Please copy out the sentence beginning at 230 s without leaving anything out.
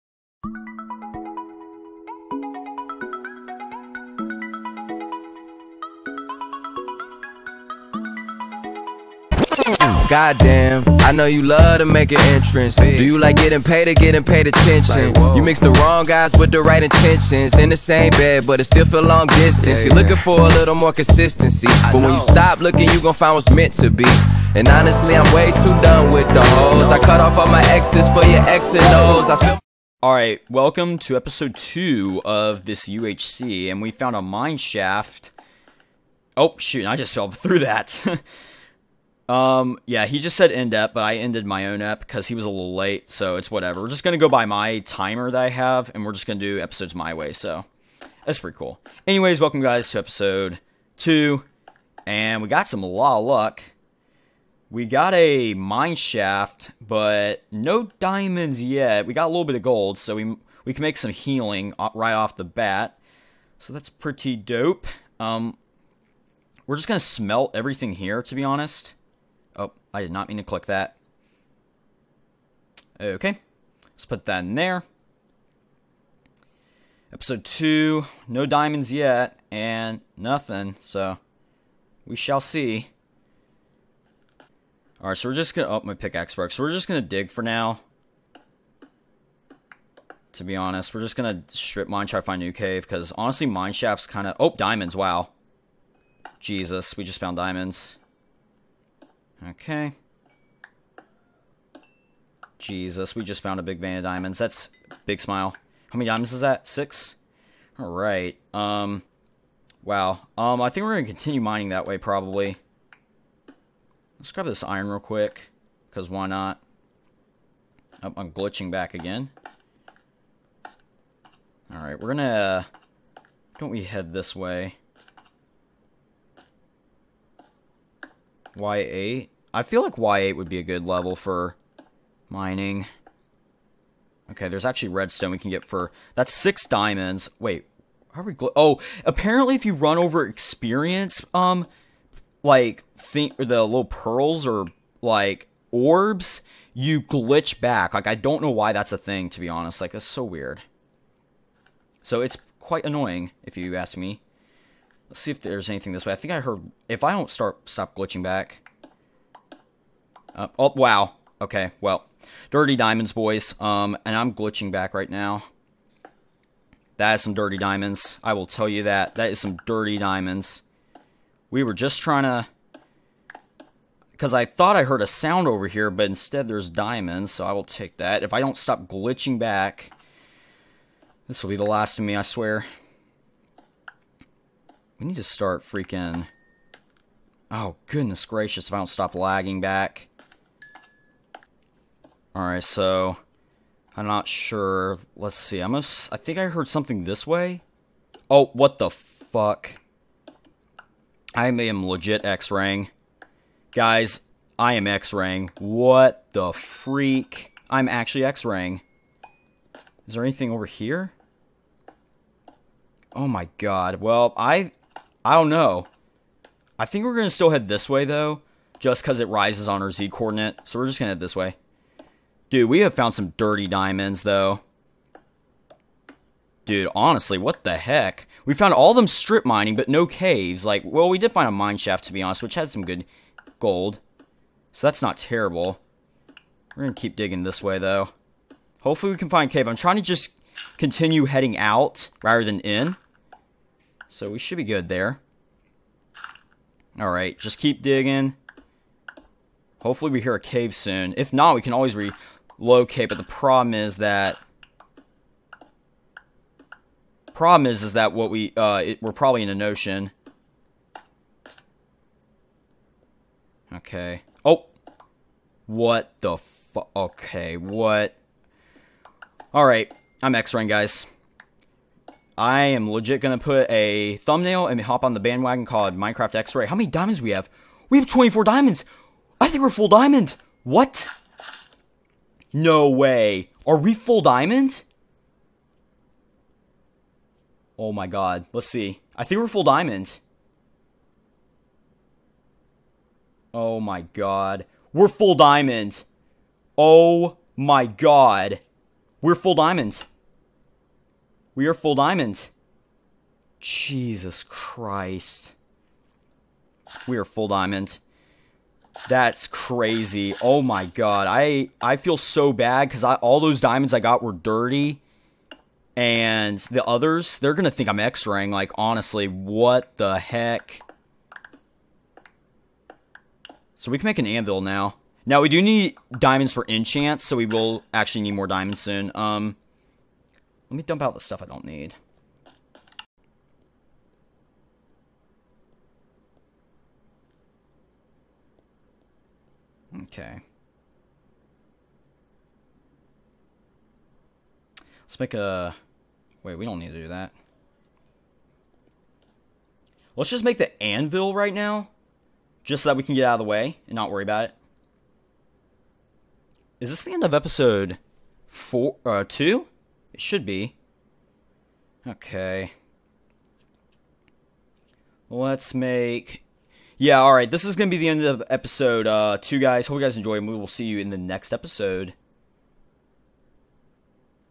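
Like, well, we did find a mine shaft, to be honest, which had some good gold.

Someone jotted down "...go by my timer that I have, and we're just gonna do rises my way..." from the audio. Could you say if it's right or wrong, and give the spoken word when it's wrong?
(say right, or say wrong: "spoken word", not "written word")
wrong: "episodes", not "rises".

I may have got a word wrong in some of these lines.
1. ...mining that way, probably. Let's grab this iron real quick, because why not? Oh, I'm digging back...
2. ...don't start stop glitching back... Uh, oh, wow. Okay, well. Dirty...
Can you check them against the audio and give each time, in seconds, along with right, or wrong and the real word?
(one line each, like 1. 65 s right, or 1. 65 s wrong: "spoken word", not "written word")
1. 111 s wrong: "glitching", not "digging"
2. 157 s right.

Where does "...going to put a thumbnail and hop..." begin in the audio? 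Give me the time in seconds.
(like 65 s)
273 s.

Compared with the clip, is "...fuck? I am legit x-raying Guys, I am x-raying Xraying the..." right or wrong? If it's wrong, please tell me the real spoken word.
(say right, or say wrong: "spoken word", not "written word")
wrong: "What", not "Xraying".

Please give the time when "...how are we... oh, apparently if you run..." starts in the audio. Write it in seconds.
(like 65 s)
138 s.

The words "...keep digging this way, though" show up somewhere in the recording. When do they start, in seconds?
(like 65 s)
237 s.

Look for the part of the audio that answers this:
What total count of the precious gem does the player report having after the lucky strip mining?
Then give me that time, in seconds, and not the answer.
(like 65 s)
278 s.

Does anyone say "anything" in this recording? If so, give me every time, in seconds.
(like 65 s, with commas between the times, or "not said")
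155 s, 210 s.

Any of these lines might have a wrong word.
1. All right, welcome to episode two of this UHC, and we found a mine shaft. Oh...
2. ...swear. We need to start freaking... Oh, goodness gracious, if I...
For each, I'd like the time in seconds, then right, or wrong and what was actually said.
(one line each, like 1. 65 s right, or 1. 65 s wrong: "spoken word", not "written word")
1. 30 s right
2. 182 s right.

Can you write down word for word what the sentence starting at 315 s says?
And the others, they're gonna think I'm X-raying.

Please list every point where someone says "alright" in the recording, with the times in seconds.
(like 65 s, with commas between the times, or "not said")
85 s, 107 s, 121 s, 192 s, 246 s, 269 s, 367 s.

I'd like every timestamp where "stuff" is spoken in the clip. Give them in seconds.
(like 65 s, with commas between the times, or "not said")
331 s.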